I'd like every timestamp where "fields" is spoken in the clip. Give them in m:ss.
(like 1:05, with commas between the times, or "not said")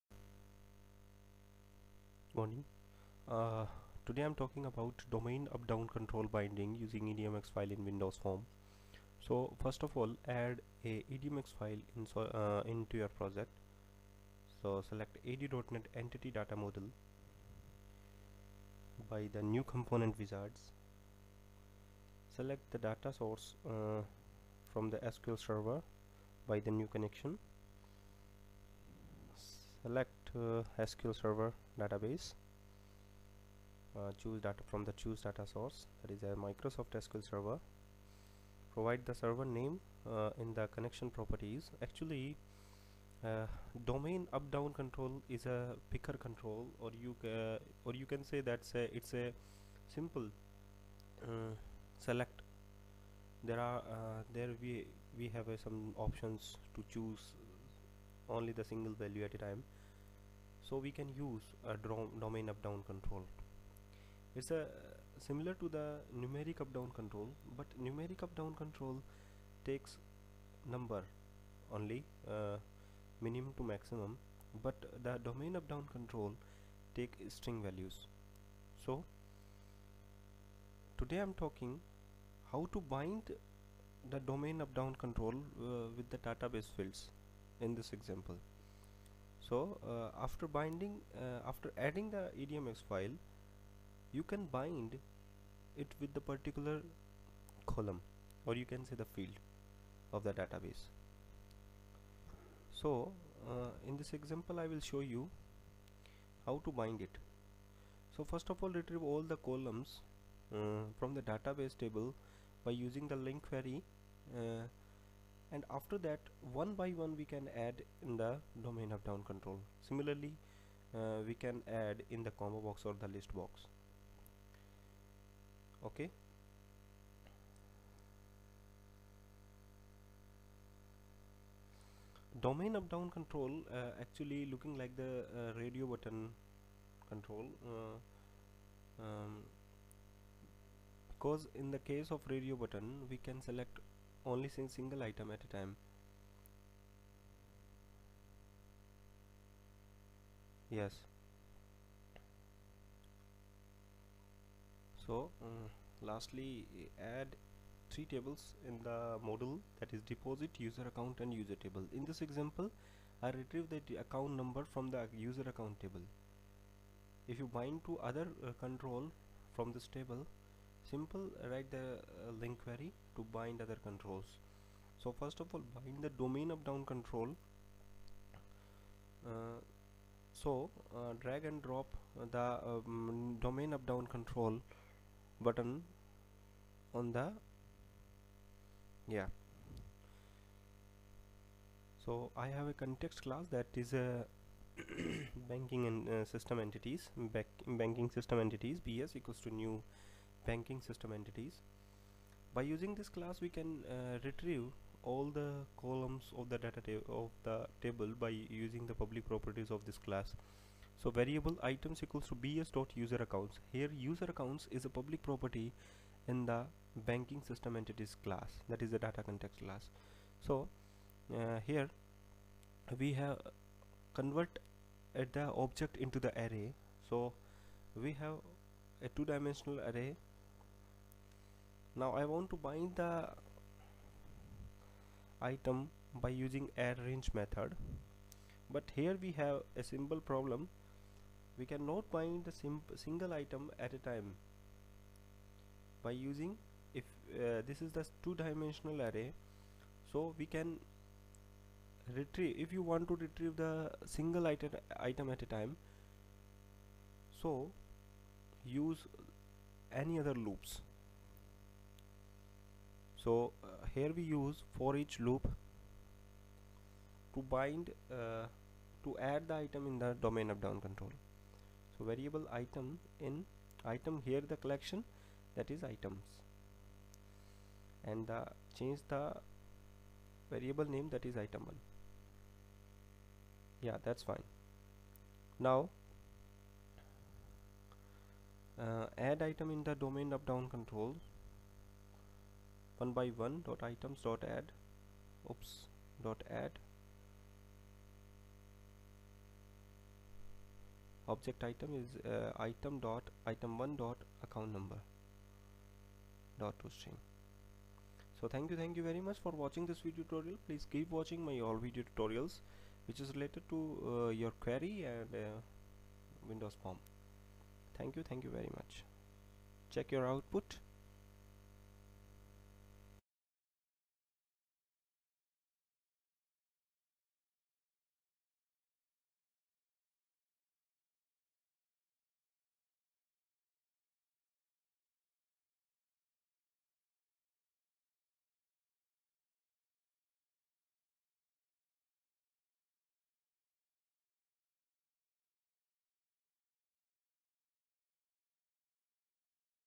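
1:26, 1:39.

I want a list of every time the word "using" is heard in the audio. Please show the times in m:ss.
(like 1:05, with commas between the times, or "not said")
0:06, 1:52, 3:22, 3:28, 3:56, 4:06.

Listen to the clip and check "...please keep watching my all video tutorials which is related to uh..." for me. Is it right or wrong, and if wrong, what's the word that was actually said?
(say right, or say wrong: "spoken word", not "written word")
right.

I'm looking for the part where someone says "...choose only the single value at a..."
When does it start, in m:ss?
0:56.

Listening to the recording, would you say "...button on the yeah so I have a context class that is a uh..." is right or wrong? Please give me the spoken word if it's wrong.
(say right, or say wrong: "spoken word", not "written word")
right.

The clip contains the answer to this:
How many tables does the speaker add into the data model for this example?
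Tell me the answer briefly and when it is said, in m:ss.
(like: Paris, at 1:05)
3, at 2:37.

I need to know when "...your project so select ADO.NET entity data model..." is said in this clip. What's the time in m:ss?
0:12.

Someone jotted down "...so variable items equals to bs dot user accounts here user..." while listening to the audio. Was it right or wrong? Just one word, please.
right.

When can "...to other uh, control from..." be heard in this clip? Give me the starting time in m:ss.
2:47.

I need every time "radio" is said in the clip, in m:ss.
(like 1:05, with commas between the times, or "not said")
2:15, 2:22.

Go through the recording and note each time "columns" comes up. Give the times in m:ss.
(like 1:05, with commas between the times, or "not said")
1:37, 1:49, 3:25.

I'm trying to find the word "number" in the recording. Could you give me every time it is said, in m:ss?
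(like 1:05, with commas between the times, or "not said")
1:10, 2:44, 5:04.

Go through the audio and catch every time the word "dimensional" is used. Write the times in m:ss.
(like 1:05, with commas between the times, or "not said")
3:49, 4:08.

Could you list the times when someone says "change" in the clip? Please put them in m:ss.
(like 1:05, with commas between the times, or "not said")
4:38.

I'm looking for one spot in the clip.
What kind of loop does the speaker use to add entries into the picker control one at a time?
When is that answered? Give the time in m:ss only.
4:24.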